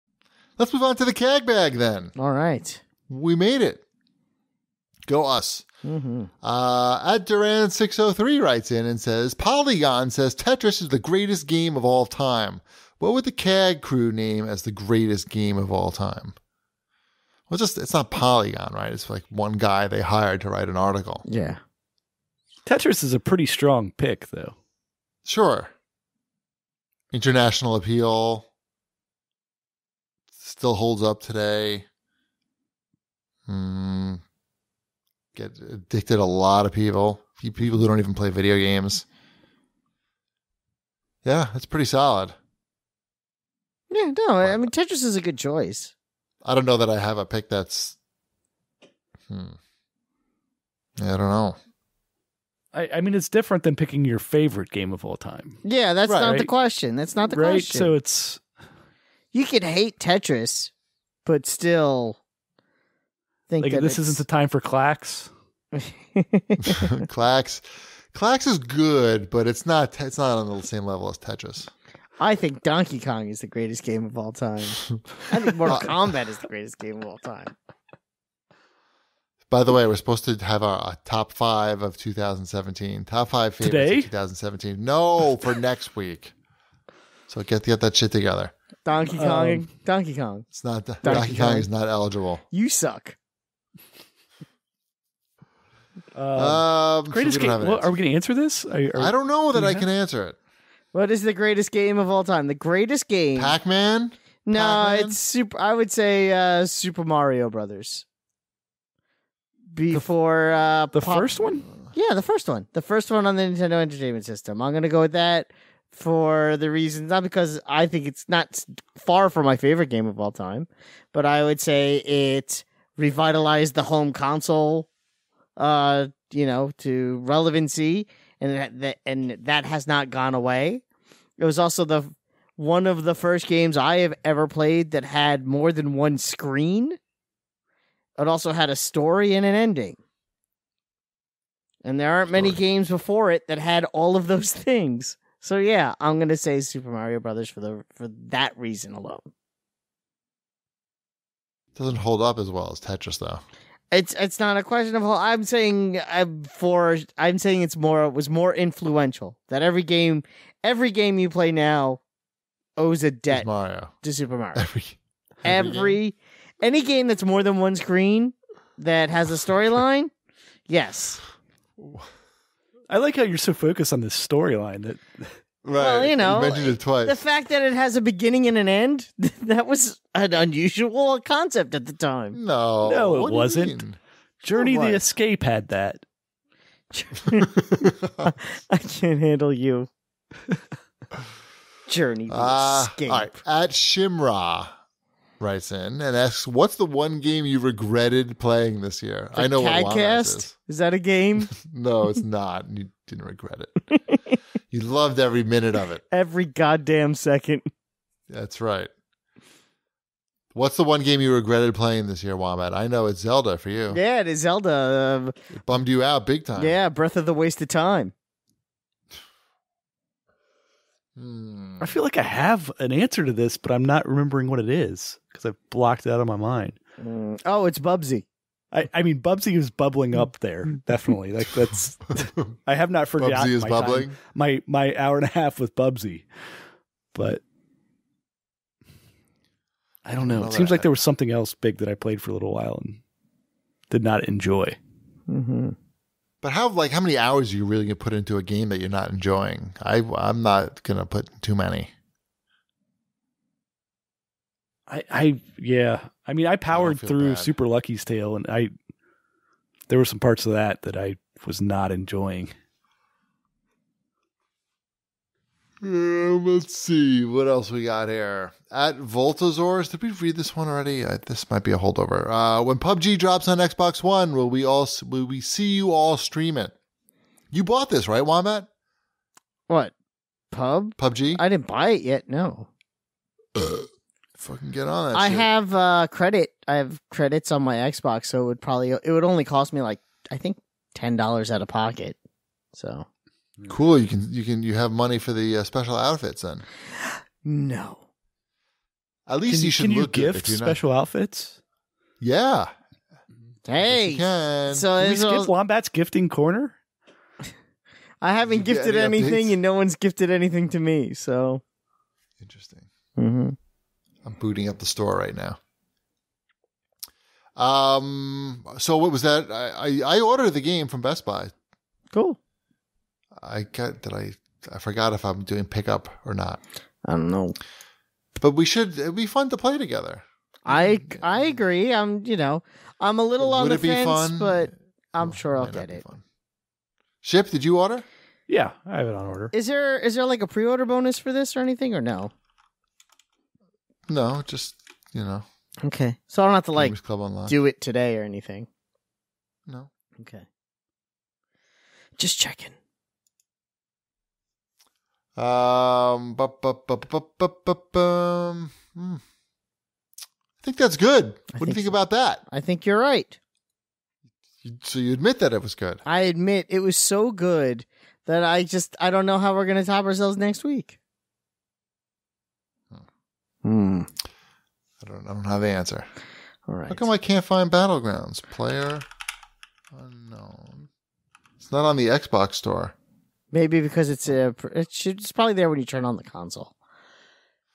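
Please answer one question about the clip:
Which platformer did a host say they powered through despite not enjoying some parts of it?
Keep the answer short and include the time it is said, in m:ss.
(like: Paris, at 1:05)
Super Lucky's Tale, at 4:17.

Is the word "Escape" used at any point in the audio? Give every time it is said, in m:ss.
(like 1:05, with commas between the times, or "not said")
3:04, 3:12.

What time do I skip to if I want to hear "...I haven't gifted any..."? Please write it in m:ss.
5:08.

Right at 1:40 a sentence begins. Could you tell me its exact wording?
What is the greatest game of all time?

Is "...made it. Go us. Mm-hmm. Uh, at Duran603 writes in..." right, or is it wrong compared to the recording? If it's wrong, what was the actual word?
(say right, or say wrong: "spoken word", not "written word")
right.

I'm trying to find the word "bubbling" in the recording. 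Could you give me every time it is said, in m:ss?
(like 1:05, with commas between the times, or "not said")
3:49, 3:53.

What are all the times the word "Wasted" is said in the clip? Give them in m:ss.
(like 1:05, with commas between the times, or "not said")
3:37.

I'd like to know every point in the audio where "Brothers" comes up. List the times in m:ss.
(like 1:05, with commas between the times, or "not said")
1:47, 2:27.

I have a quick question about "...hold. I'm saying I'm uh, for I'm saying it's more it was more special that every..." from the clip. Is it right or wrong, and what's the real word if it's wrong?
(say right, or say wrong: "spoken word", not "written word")
wrong: "influential", not "special".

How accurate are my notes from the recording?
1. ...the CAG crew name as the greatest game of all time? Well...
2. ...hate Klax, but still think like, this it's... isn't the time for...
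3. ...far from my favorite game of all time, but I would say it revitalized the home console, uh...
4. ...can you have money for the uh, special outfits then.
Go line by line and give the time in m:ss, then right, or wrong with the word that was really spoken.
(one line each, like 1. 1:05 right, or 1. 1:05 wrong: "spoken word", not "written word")
1. 0:13 right
2. 0:59 wrong: "Tetris", not "Klax"
3. 1:58 right
4. 4:54 right.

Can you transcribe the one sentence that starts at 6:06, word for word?
I admit it was so good that I just I don't know how we're gonna top ourselves next week.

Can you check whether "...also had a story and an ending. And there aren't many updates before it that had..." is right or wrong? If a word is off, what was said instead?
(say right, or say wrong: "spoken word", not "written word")
wrong: "games", not "updates".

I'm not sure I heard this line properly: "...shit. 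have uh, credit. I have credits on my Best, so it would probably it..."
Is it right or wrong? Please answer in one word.
wrong.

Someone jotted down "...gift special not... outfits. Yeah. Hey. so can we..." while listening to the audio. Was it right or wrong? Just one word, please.
right.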